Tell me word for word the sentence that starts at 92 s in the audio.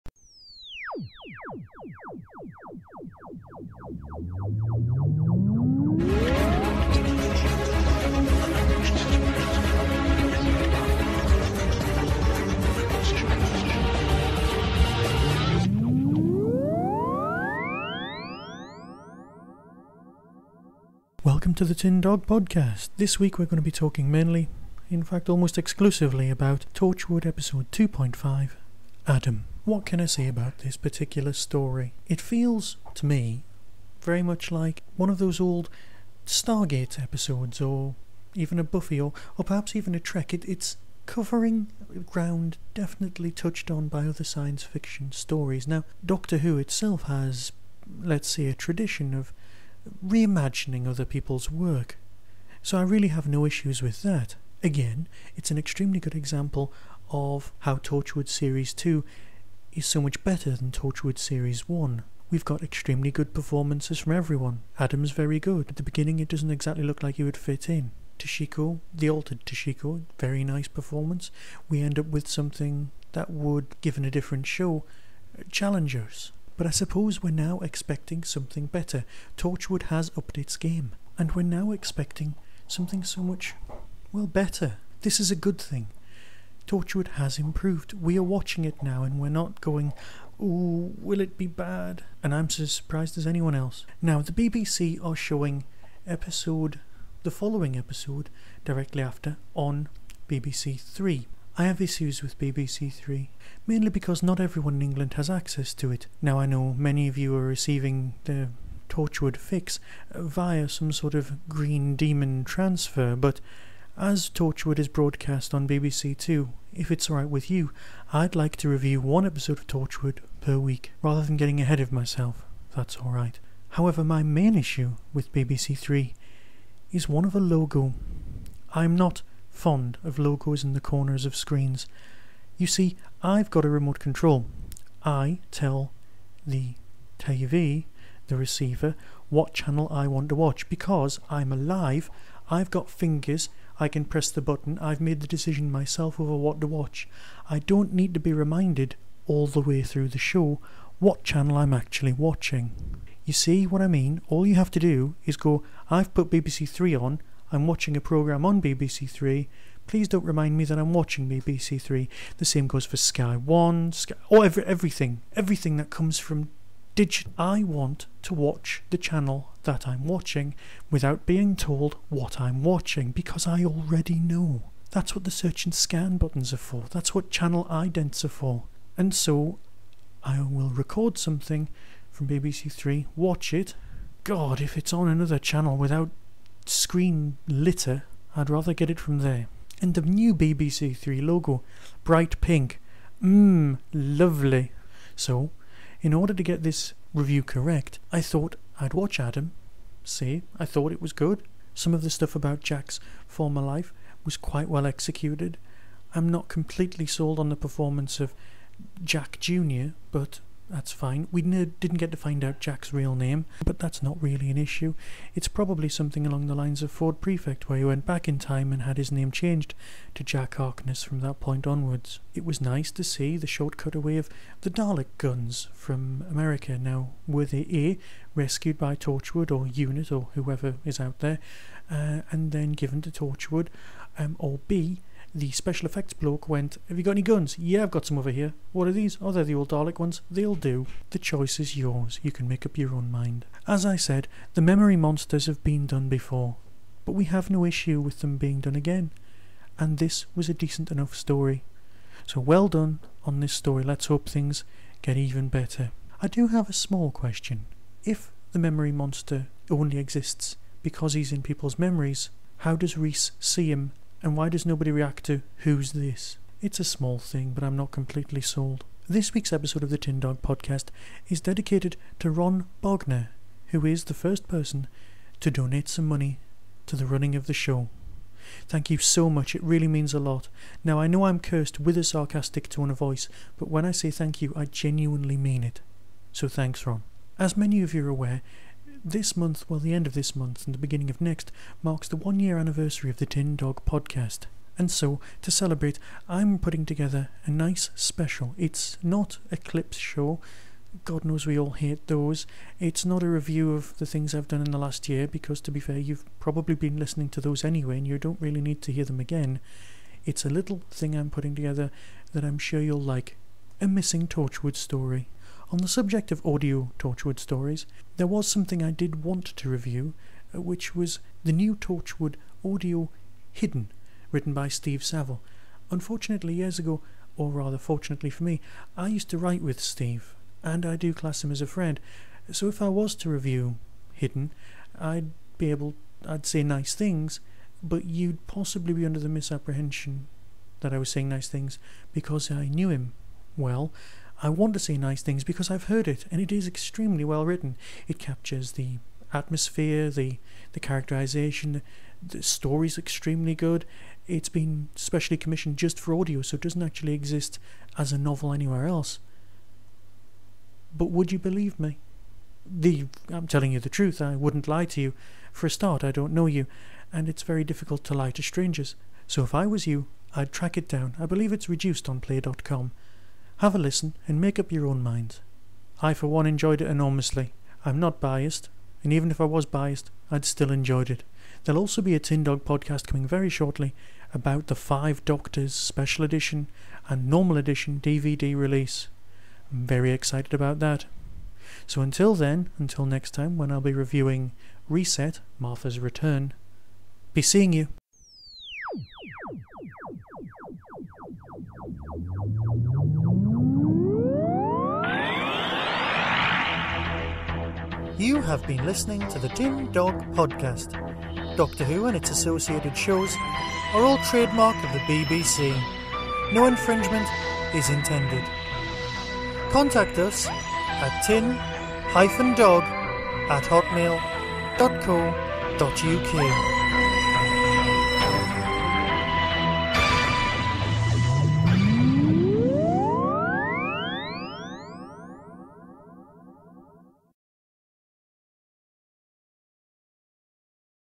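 And I'm as surprised as anyone else.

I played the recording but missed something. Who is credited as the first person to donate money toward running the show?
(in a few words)
Ron Bogner.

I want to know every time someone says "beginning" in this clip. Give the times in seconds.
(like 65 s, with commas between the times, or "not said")
65 s, 290 s.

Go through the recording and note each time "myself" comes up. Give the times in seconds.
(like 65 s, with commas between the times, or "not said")
121 s, 145 s.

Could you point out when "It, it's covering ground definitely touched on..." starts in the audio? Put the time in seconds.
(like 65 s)
40 s.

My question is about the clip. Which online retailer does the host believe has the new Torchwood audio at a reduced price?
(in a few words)
Play.com.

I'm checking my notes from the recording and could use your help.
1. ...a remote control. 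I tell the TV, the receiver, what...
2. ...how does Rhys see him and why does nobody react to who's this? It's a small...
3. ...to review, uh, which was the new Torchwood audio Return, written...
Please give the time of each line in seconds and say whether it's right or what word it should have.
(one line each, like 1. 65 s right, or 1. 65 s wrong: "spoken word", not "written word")
1. 133 s right
2. 262 s right
3. 319 s wrong: "Hidden", not "Return".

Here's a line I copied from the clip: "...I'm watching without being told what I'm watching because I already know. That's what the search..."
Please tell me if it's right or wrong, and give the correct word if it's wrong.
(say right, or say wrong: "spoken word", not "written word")
right.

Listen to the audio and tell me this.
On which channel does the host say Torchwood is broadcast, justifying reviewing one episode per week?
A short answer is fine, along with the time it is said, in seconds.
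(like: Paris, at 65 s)
BBC Two, at 115 s.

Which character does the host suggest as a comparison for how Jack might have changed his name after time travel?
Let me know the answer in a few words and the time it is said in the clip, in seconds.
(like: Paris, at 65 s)
Ford Prefect, at 216 s.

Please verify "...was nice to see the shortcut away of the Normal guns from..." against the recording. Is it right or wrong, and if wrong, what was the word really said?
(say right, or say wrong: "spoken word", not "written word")
wrong: "Dalek", not "Normal".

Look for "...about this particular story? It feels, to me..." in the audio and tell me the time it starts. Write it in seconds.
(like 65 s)
30 s.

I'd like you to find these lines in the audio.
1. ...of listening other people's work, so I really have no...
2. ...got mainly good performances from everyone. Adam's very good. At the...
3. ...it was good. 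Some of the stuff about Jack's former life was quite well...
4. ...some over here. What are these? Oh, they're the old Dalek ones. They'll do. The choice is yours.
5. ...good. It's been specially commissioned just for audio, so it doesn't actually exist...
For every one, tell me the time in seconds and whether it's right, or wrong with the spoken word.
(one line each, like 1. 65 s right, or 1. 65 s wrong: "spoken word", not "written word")
1. 49 s wrong: "reimagining", not "listening"
2. 62 s wrong: "extremely", not "mainly"
3. 200 s right
4. 238 s right
5. 353 s right.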